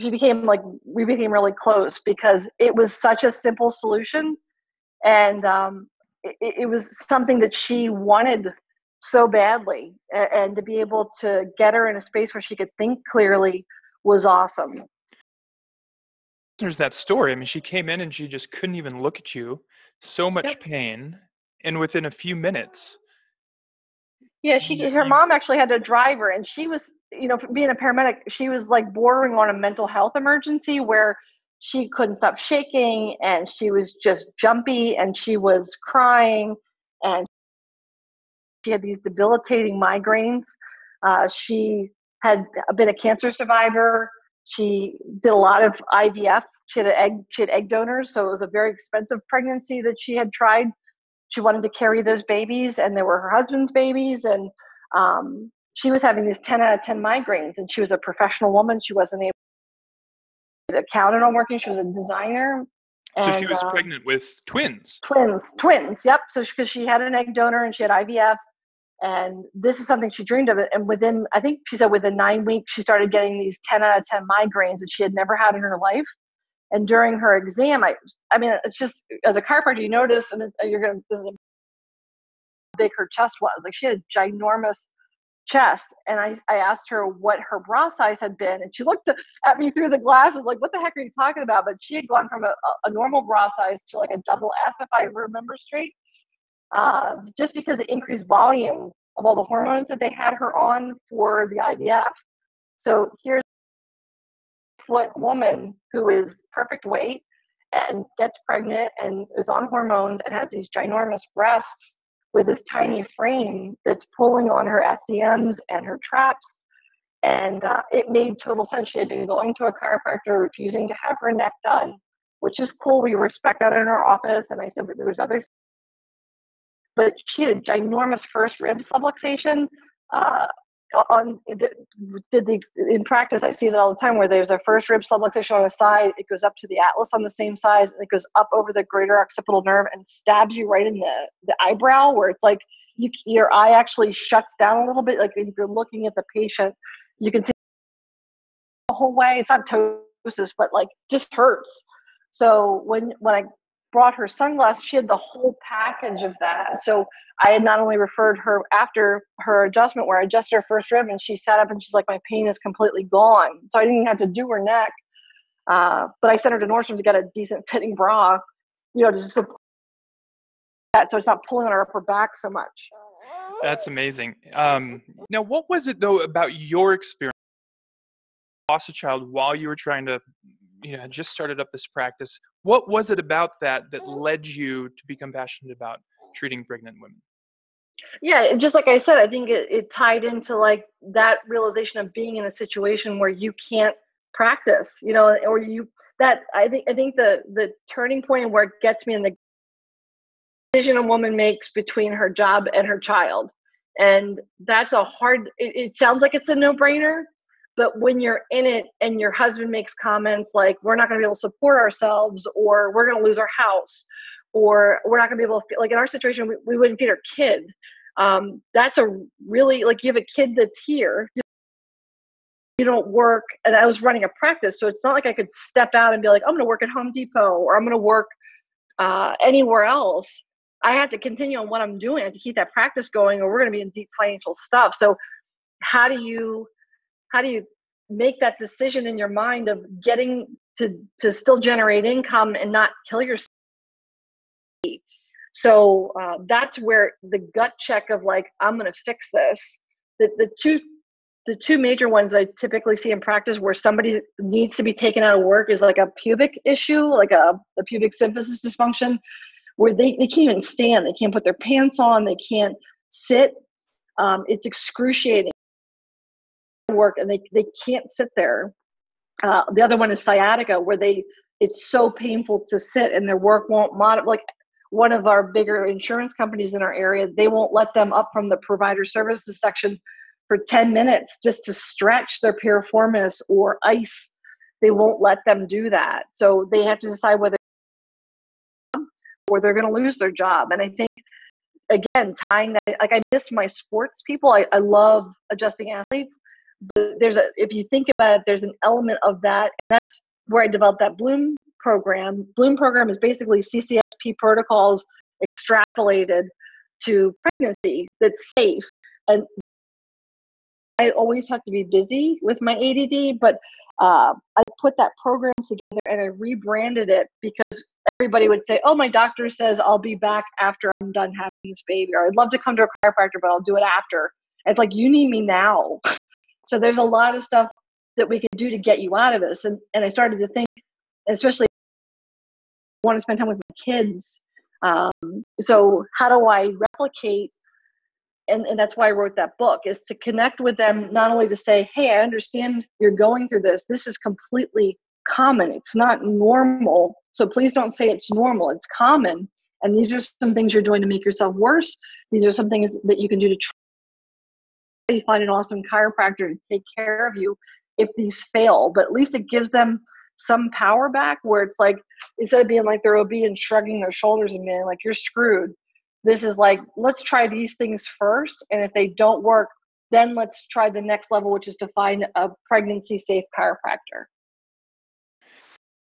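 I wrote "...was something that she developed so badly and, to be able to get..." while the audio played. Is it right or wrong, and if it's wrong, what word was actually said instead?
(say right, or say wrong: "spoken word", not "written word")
wrong: "wanted", not "developed".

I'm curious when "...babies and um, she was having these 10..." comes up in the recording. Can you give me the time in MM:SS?
00:53.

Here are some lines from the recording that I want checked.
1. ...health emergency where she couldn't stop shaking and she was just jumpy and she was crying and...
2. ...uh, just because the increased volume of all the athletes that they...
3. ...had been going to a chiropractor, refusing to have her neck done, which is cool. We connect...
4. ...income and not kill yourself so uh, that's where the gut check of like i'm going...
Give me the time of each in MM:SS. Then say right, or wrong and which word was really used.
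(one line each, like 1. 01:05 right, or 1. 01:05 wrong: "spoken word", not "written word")
1. 00:29 right
2. 01:36 wrong: "hormones", not "athletes"
3. 01:58 wrong: "respect", not "connect"
4. 04:02 right.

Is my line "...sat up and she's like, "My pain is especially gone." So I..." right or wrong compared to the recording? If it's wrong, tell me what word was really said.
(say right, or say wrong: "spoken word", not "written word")
wrong: "completely", not "especially".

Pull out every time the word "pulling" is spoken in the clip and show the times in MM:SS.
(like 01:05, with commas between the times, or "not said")
01:54, 02:51.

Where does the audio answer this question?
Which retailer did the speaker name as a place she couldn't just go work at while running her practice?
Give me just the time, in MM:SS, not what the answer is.
03:46.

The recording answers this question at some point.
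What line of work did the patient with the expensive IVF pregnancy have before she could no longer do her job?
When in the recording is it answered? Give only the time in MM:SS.
01:01.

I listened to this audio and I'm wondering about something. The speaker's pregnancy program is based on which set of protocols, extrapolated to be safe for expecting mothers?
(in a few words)
CCSP.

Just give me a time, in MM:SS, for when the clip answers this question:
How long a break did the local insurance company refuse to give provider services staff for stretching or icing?
04:40.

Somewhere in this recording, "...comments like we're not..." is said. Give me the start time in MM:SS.
03:29.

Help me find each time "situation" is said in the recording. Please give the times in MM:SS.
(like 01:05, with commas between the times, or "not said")
03:12, 03:36.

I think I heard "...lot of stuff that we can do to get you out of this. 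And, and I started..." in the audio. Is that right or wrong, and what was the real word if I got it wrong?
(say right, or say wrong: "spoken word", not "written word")
right.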